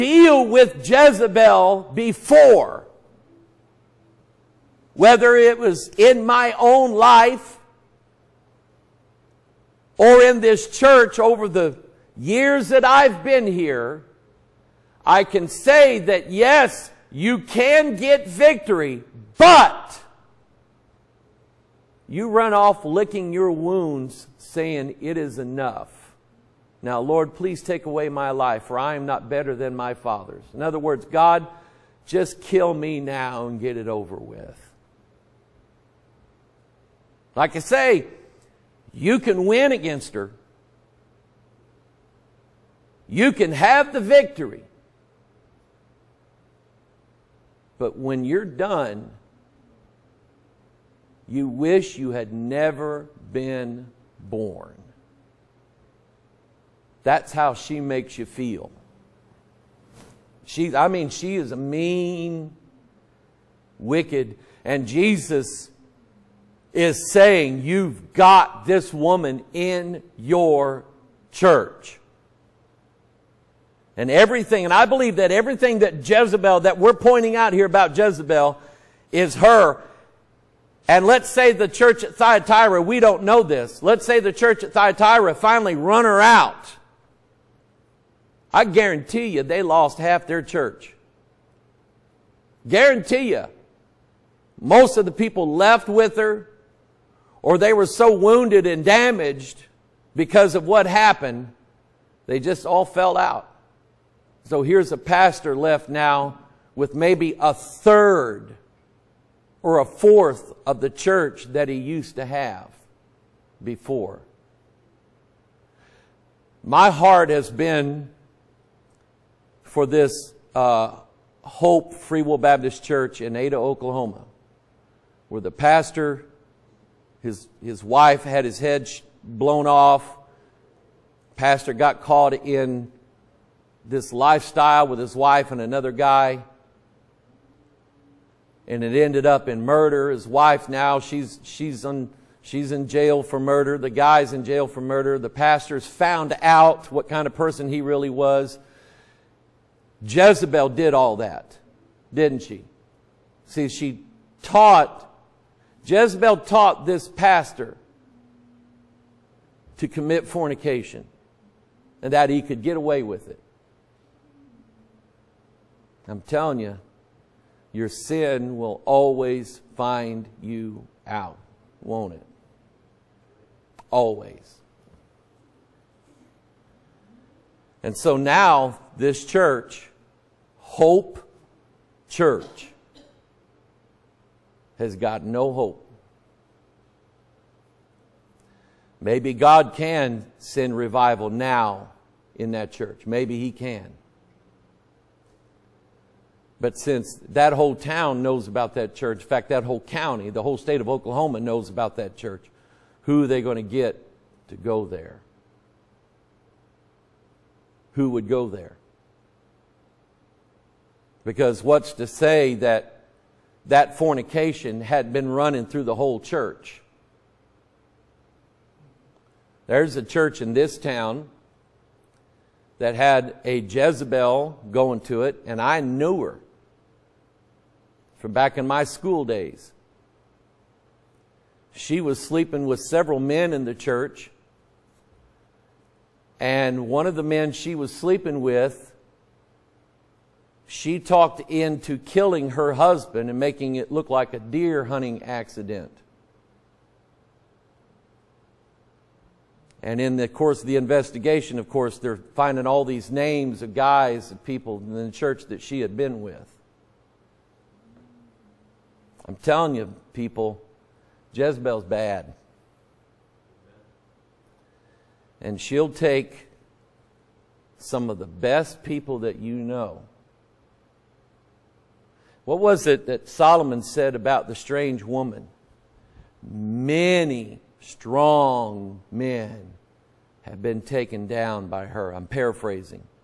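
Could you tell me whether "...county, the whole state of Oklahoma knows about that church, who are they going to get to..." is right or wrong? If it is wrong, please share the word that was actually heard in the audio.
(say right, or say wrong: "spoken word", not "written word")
right.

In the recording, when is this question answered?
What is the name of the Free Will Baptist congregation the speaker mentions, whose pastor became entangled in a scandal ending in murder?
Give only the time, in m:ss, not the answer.
2:01.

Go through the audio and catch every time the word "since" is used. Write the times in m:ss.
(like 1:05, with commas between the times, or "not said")
3:16.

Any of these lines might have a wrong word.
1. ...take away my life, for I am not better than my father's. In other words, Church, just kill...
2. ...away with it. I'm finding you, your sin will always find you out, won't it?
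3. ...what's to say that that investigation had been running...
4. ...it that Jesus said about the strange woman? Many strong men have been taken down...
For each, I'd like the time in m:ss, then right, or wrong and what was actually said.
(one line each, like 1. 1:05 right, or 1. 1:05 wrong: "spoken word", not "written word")
1. 0:27 wrong: "God", not "Church"
2. 2:42 wrong: "telling", not "finding"
3. 3:31 wrong: "fornication", not "investigation"
4. 4:32 wrong: "Solomon", not "Jesus".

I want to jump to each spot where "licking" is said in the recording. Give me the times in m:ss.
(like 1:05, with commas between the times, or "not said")
0:22.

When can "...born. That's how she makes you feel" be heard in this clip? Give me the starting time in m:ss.
0:54.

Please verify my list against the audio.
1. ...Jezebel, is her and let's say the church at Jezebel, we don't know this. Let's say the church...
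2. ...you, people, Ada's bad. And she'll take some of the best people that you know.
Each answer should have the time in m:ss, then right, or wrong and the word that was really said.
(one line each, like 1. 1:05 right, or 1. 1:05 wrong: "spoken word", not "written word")
1. 1:17 wrong: "Thyatira", not "Jezebel"
2. 4:19 wrong: "Jezebel", not "Ada".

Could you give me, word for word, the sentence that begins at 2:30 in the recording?
Jezebel did all that, didn't she?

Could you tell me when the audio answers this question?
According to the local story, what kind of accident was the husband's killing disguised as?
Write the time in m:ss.
4:04.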